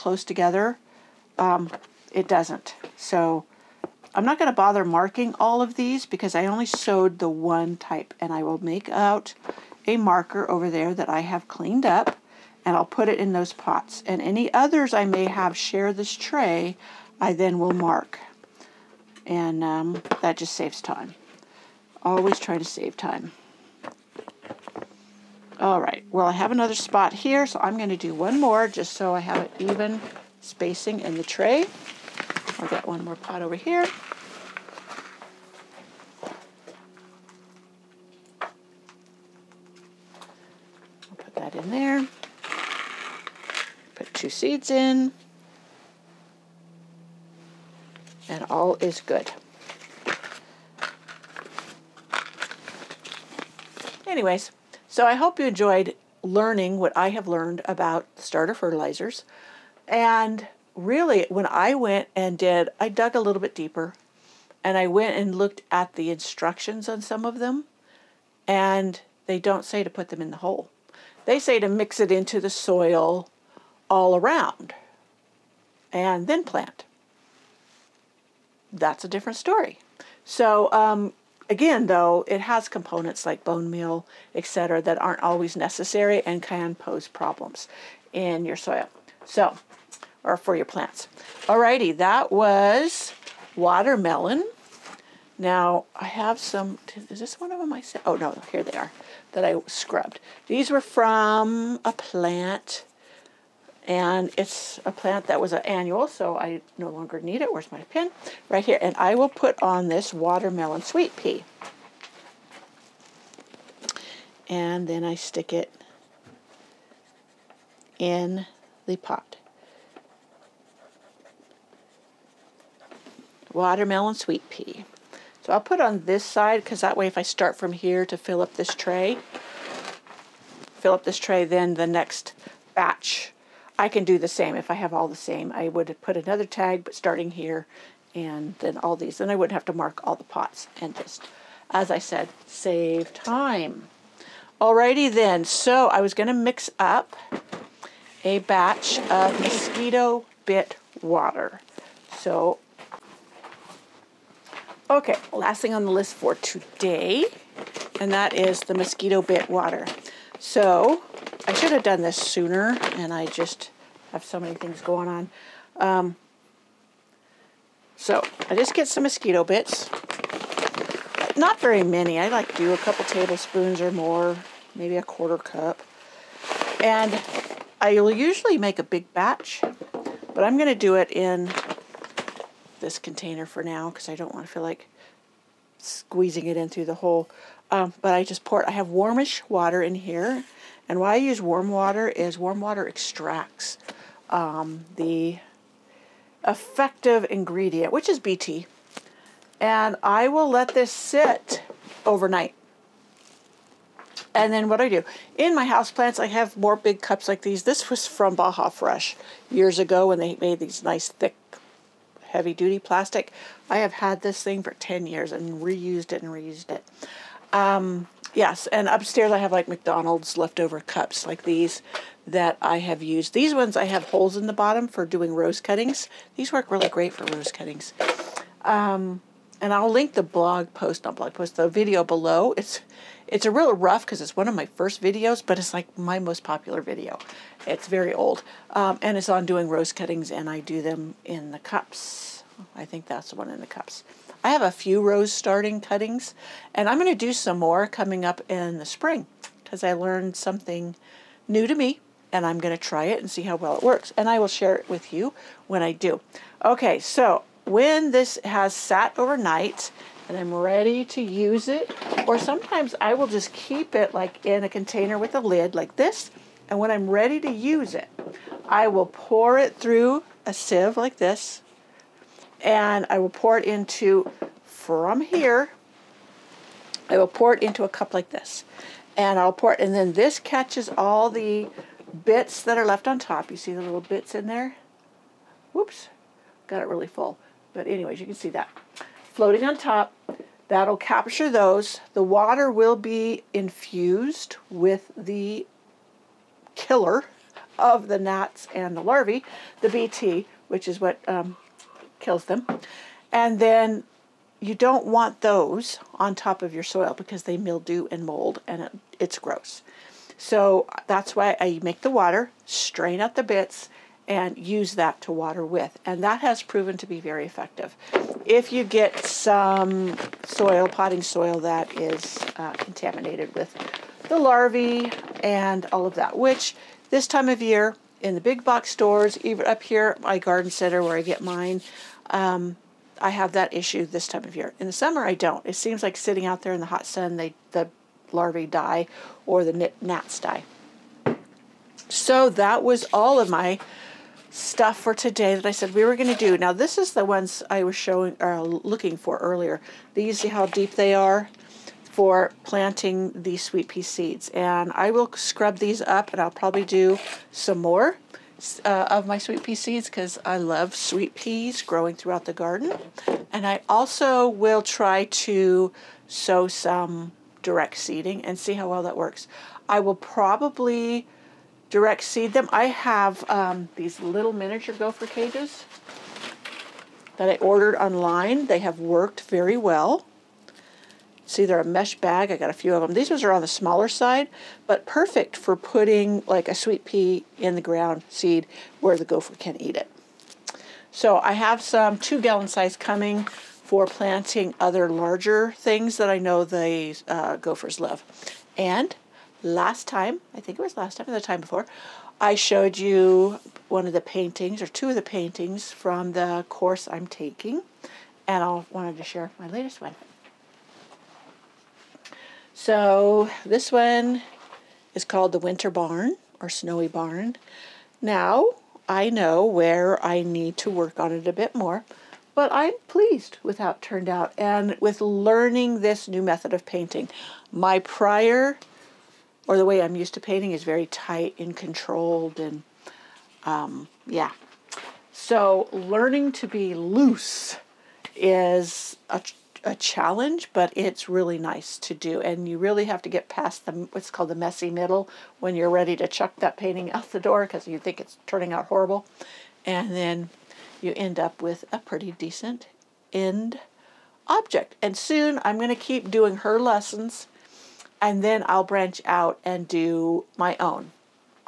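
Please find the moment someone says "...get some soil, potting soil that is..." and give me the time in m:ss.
5:18.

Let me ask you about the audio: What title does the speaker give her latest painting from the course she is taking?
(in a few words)
Winter Barn.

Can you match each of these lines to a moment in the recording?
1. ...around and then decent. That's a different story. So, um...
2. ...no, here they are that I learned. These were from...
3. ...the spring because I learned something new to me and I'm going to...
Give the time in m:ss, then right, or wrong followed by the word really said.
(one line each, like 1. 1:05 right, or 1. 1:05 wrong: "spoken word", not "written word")
1. 1:14 wrong: "plant", not "decent"
2. 1:38 wrong: "scrubbed", not "learned"
3. 4:08 right.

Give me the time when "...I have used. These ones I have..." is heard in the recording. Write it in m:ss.
3:42.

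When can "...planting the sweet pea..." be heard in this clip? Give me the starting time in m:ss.
5:52.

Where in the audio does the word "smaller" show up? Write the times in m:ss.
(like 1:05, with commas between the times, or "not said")
6:23.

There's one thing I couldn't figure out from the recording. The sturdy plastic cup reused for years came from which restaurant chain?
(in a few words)
Baja Fresh.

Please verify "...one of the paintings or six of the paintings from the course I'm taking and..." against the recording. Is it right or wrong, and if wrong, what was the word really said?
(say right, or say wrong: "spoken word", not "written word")
wrong: "two", not "six".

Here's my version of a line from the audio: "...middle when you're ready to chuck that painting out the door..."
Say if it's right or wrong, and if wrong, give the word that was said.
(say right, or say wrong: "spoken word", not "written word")
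right.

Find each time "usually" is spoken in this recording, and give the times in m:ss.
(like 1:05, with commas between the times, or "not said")
2:58.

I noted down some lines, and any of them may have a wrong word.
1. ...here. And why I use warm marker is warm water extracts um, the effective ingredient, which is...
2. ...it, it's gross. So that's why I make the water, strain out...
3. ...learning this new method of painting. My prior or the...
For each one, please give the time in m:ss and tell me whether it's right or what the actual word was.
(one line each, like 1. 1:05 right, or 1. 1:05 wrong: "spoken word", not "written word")
1. 3:09 wrong: "water", not "marker"
2. 5:08 right
3. 7:05 right.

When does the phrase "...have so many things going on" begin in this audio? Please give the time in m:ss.
2:44.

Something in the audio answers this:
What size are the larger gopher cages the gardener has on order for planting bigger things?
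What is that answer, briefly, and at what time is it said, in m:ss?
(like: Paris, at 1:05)
2 gallon, at 6:32.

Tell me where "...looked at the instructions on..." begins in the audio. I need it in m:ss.
1:05.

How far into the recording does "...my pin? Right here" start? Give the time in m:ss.
1:47.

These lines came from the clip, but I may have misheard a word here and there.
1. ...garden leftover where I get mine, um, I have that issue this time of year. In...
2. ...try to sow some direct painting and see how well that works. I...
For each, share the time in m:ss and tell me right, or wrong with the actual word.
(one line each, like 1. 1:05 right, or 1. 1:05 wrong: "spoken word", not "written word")
1. 5:30 wrong: "center", not "leftover"
2. 6:04 wrong: "seeding", not "painting".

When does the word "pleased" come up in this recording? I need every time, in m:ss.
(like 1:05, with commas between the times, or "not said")
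7:03.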